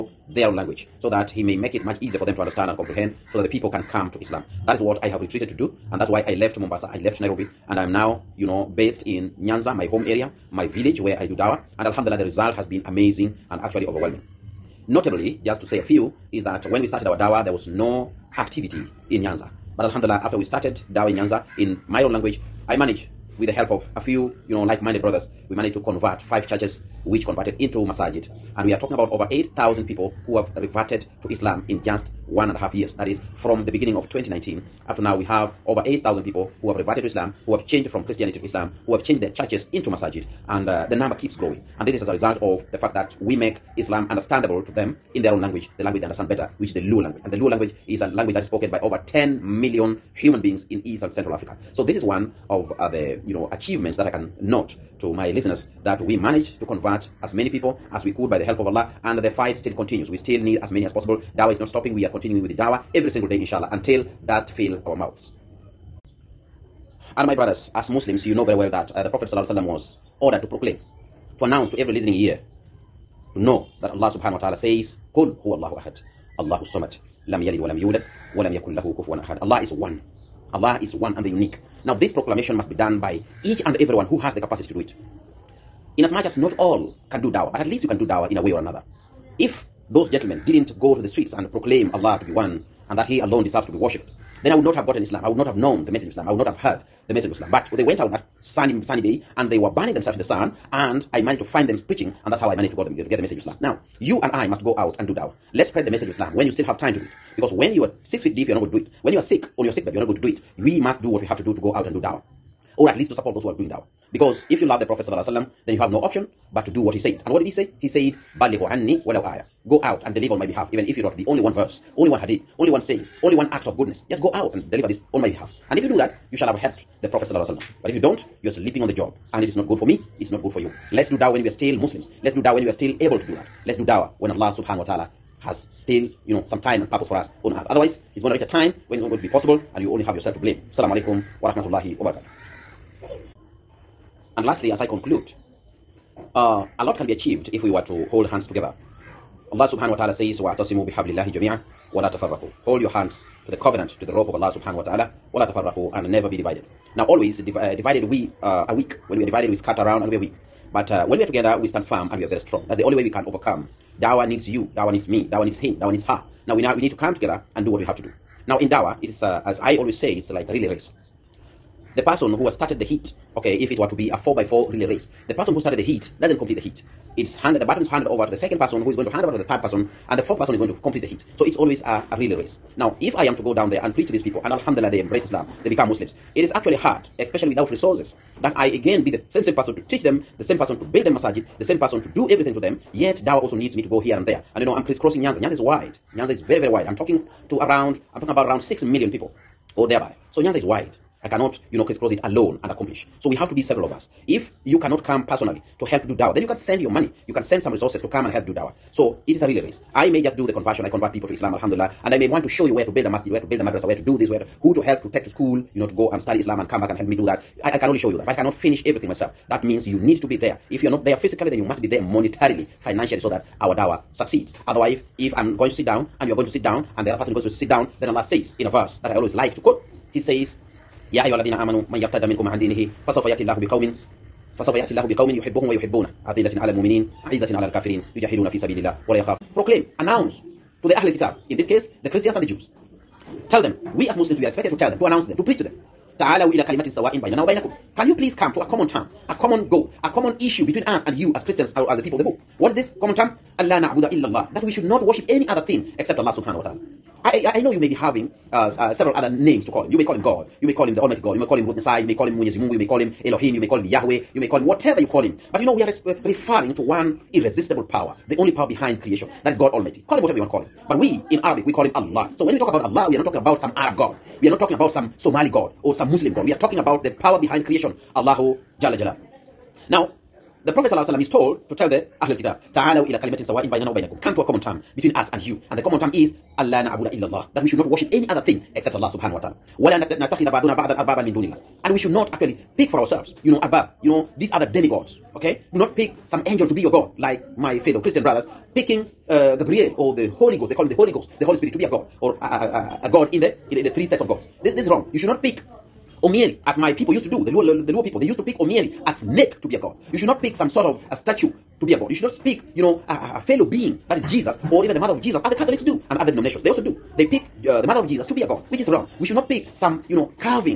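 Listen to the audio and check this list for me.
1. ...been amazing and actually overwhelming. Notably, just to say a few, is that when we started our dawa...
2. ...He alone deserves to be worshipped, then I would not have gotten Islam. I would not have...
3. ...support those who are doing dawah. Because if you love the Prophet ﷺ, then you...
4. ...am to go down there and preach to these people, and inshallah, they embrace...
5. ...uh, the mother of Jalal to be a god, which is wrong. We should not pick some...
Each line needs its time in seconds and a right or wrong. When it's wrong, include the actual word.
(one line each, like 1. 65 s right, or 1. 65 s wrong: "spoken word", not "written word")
1. 12 s right
2. 93 s right
3. 113 s right
4. 183 s wrong: "alhamdulillah", not "inshallah"
5. 317 s wrong: "Jesus", not "Jalal".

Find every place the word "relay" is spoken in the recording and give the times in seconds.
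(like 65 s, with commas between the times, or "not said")
170 s, 174 s, 182 s, 209 s.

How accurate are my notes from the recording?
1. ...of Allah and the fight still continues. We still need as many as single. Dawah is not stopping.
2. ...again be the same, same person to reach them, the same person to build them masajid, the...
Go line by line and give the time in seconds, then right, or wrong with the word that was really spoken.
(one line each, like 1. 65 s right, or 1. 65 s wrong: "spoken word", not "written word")
1. 58 s wrong: "possible", not "single"
2. 188 s wrong: "teach", not "reach".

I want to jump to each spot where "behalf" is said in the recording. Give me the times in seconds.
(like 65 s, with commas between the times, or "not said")
120 s, 125 s.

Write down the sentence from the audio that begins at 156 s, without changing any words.
Now always div uh, divided we uh, are weak.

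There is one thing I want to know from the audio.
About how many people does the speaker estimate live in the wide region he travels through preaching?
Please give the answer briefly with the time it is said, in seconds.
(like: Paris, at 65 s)
6 million, at 198 s.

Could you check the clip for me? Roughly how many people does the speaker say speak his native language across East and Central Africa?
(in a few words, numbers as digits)
over 10 million.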